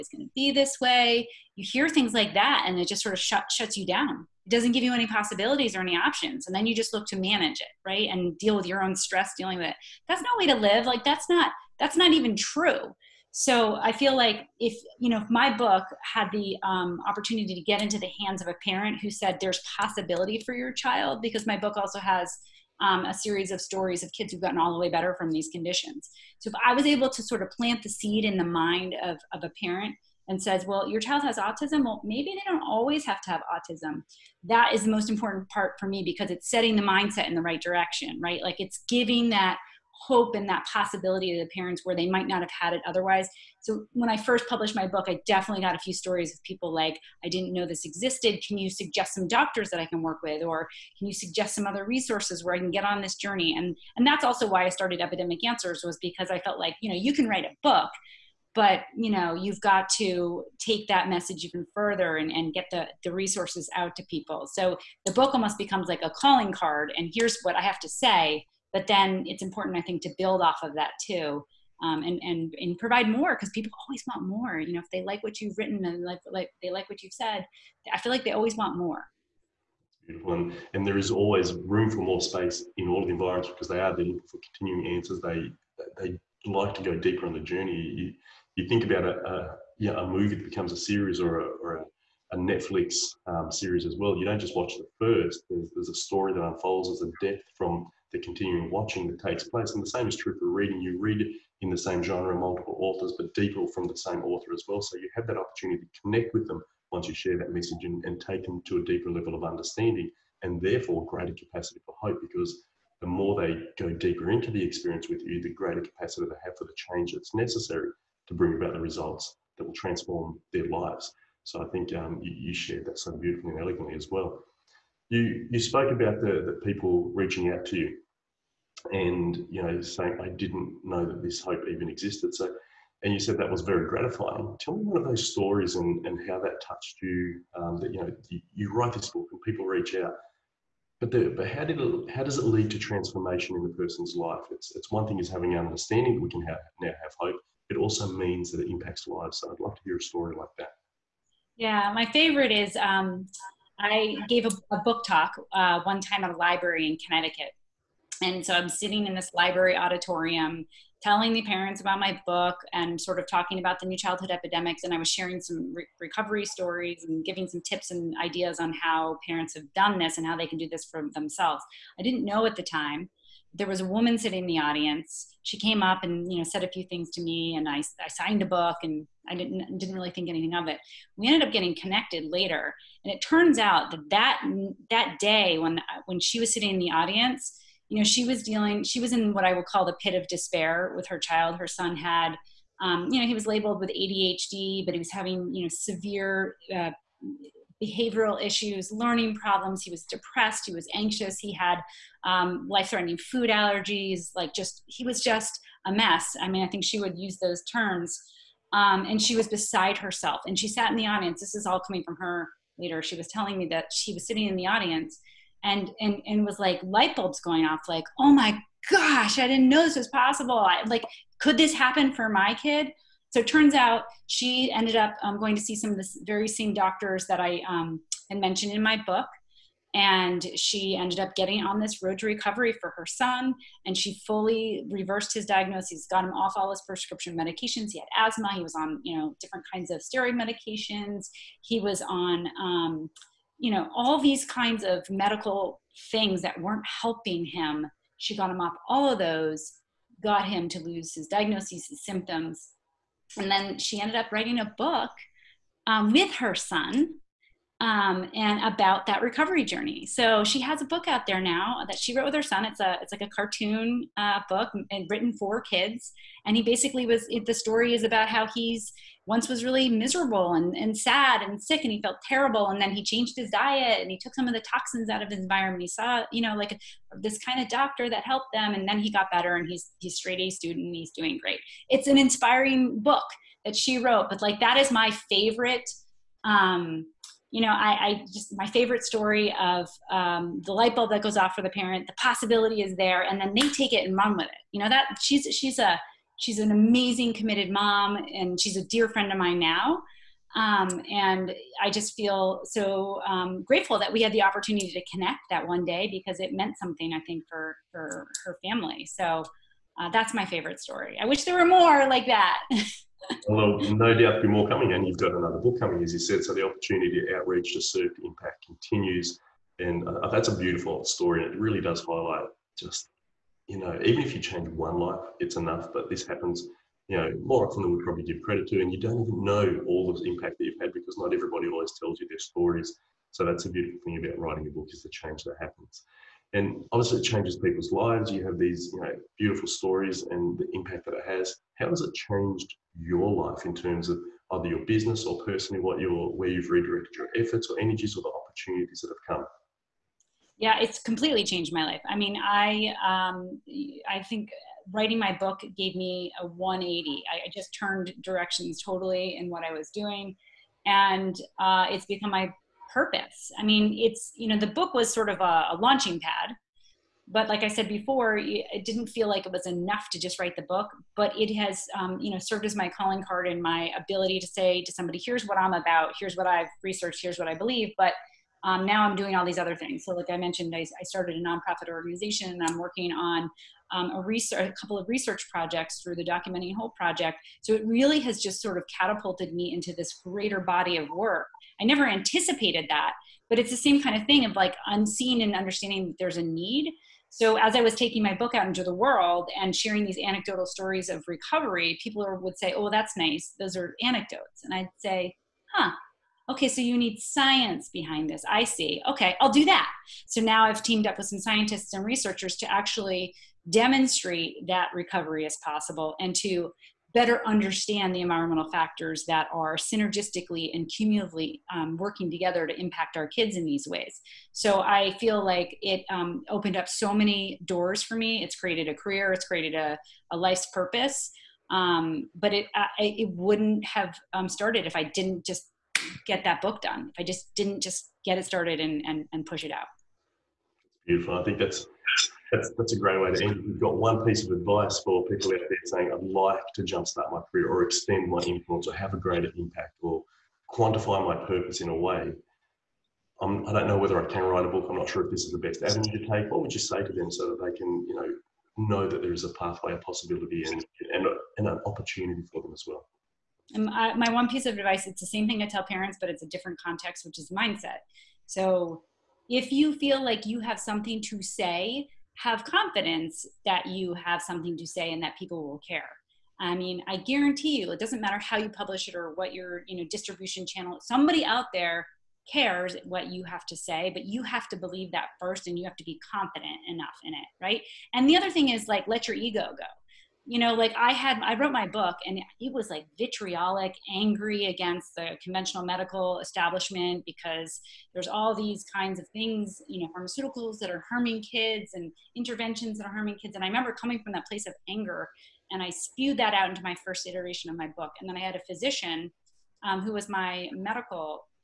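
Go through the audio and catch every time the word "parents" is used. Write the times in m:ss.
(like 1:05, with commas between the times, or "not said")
0:18, 0:29, 0:41, 2:41, 2:49, 4:51, 7:45.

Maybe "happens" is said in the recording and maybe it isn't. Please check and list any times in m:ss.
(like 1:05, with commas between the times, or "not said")
3:41, 5:26, 5:35.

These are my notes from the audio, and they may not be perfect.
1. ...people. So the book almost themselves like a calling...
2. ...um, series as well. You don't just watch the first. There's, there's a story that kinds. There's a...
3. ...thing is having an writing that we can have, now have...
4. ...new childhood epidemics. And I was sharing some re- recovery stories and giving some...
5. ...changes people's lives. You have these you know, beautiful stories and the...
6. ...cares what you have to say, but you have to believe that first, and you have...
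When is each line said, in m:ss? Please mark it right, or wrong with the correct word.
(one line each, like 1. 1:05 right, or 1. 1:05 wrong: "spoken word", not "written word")
1. 1:04 wrong: "becomes", not "themselves"
2. 1:33 wrong: "unfolds", not "kinds"
3. 2:25 wrong: "understanding", not "writing"
4. 2:43 right
5. 5:37 right
6. 8:02 right.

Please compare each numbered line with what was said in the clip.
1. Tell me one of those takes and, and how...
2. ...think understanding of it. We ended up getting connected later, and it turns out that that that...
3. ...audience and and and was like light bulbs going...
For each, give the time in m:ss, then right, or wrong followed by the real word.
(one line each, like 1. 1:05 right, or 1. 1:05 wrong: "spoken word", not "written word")
1. 2:14 wrong: "stories", not "takes"
2. 3:00 wrong: "anything", not "understanding"
3. 3:34 right.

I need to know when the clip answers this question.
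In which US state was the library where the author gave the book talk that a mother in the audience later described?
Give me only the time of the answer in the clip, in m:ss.
2:36.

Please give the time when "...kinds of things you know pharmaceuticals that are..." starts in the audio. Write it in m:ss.
8:18.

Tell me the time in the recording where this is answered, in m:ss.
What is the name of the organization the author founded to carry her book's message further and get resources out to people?
0:55.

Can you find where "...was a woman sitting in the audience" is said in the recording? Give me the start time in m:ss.
2:53.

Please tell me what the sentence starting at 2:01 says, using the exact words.
So I think um, you, you, shared that so beautifully and elegantly as well.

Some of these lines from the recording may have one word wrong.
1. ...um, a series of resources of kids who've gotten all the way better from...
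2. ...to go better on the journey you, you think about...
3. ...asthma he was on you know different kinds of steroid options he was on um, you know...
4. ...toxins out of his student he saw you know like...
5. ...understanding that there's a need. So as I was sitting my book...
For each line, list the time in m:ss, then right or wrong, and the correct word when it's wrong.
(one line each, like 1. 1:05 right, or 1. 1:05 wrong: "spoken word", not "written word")
1. 0:22 wrong: "stories", not "resources"
2. 1:26 wrong: "deeper", not "better"
3. 3:58 wrong: "medications", not "options"
4. 4:34 wrong: "environment", not "student"
5. 6:35 wrong: "taking", not "sitting".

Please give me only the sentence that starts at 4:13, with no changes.
And then she ended up writing a book um, with her son um, and about that recovery journey.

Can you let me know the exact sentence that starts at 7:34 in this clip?
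I'm not sure if this is the best avenue to take.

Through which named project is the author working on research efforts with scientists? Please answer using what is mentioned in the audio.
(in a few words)
Documenting Hope.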